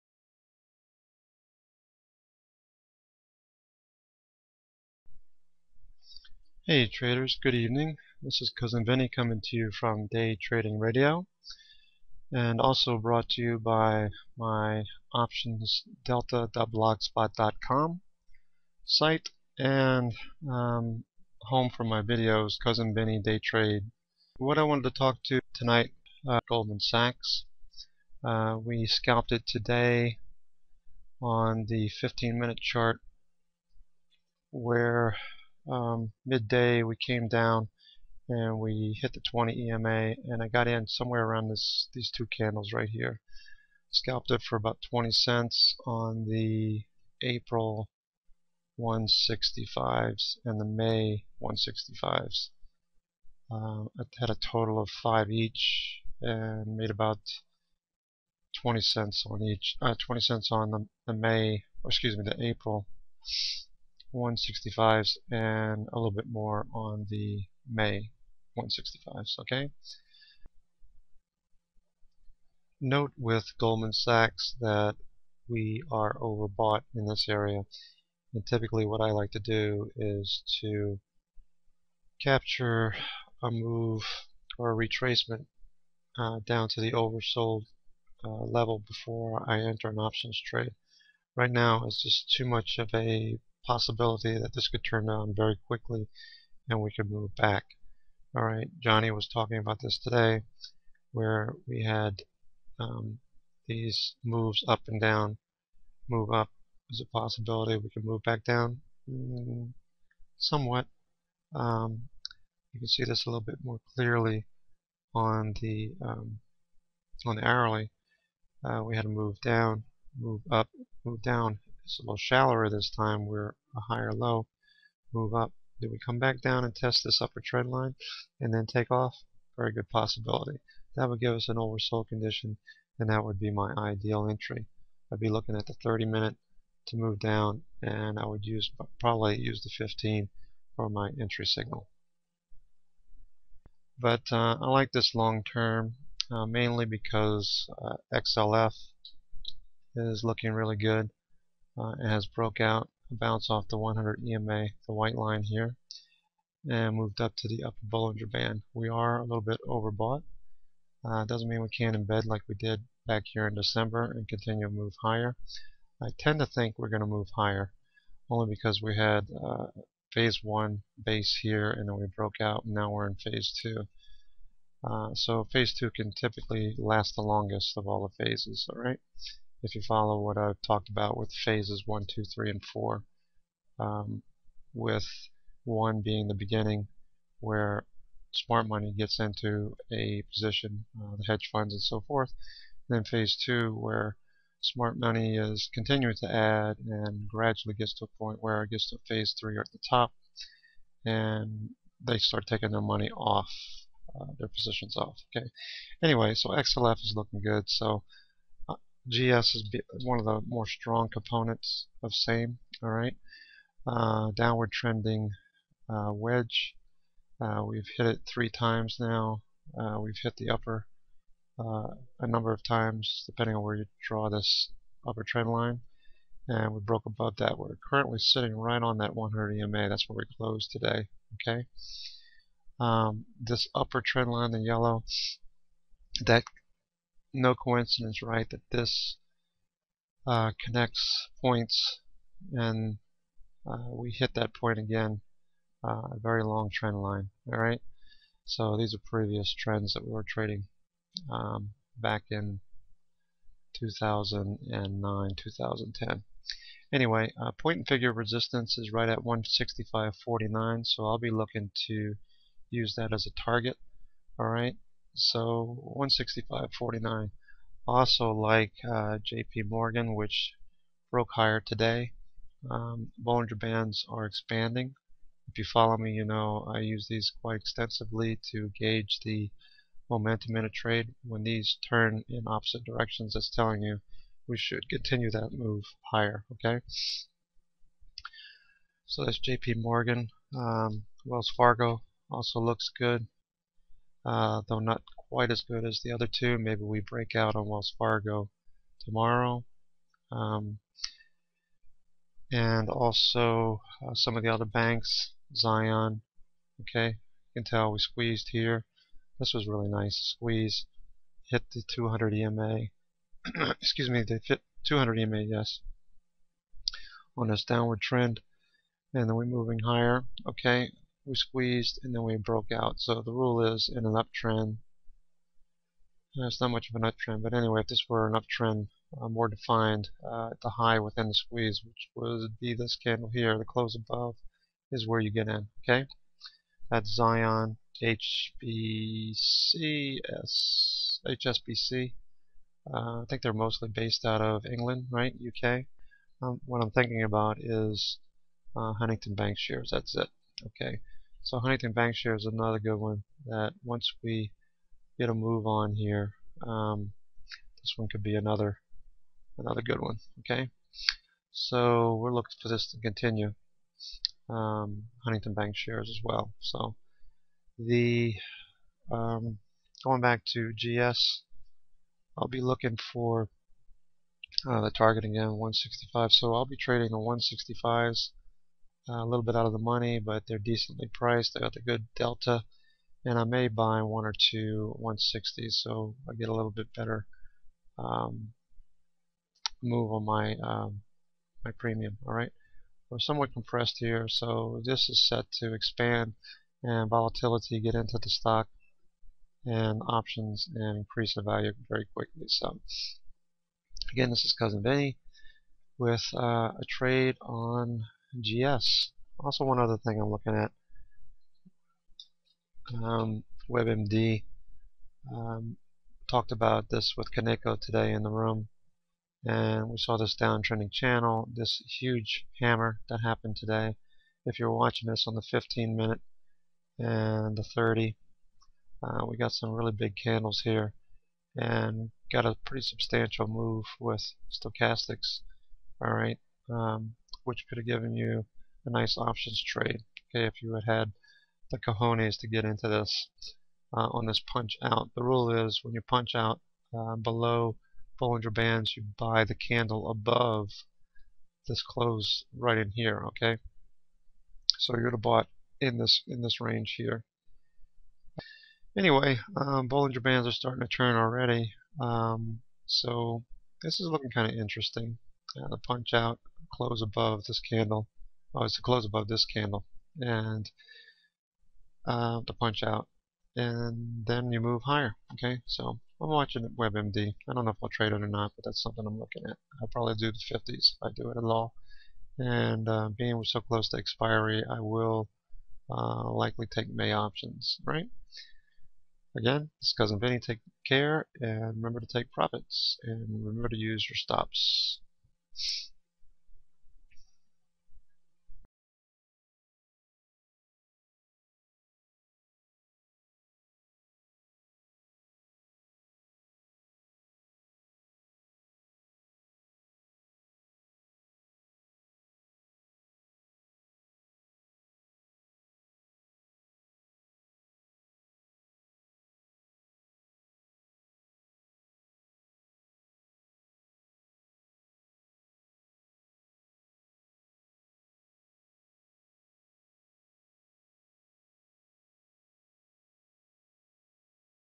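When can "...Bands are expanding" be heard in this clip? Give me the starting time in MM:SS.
04:33.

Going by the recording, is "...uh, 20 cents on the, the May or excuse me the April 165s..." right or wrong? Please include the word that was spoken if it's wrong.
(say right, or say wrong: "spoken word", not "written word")
right.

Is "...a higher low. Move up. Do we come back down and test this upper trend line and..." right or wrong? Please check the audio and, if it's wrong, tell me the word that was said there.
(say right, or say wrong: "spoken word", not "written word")
right.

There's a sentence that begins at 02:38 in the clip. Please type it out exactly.
We are a little bit overbought.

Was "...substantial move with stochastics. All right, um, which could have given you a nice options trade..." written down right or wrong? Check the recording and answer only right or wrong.
right.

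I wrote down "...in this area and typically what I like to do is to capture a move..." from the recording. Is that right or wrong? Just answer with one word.
right.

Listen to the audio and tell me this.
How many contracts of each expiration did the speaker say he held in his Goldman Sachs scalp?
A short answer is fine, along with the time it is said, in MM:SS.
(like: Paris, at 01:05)
5, at 00:55.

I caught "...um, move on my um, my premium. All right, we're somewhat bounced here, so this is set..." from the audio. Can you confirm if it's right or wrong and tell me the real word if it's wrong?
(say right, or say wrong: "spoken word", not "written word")
wrong: "compressed", not "bounced".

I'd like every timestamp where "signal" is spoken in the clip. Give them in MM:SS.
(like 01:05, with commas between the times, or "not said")
02:21.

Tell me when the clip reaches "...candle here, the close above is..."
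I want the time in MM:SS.
05:32.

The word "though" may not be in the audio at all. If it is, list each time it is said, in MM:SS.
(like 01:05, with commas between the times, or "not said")
04:54.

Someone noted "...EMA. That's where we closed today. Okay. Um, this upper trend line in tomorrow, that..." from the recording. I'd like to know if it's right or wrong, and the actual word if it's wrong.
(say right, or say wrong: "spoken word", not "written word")
wrong: "yellow", not "tomorrow".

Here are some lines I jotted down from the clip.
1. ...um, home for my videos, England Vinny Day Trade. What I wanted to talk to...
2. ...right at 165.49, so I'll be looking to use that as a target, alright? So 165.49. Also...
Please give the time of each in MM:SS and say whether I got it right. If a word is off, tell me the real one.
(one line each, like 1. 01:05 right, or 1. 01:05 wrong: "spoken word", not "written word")
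1. 00:20 wrong: "Cousin", not "England"
2. 04:18 right.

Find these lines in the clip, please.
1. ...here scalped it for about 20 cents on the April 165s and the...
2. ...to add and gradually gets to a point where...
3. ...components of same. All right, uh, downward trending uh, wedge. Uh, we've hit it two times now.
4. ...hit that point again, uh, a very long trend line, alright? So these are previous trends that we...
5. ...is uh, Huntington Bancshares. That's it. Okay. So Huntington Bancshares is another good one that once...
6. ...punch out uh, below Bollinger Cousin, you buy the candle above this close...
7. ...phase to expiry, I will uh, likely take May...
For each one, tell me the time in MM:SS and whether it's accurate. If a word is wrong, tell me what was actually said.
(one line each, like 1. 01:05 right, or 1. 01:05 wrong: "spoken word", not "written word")
1. 00:42 right
2. 03:16 right
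3. 03:31 wrong: "three", not "two"
4. 04:04 right
5. 05:47 right
6. 07:26 wrong: "Bands", not "Cousin"
7. 08:03 wrong: "close", not "phase".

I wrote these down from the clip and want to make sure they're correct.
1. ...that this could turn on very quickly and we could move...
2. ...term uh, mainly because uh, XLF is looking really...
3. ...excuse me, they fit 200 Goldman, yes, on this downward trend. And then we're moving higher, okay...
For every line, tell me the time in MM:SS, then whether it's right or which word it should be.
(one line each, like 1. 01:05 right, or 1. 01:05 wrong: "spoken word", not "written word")
1. 01:34 right
2. 02:25 right
3. 05:13 wrong: "EMA", not "Goldman".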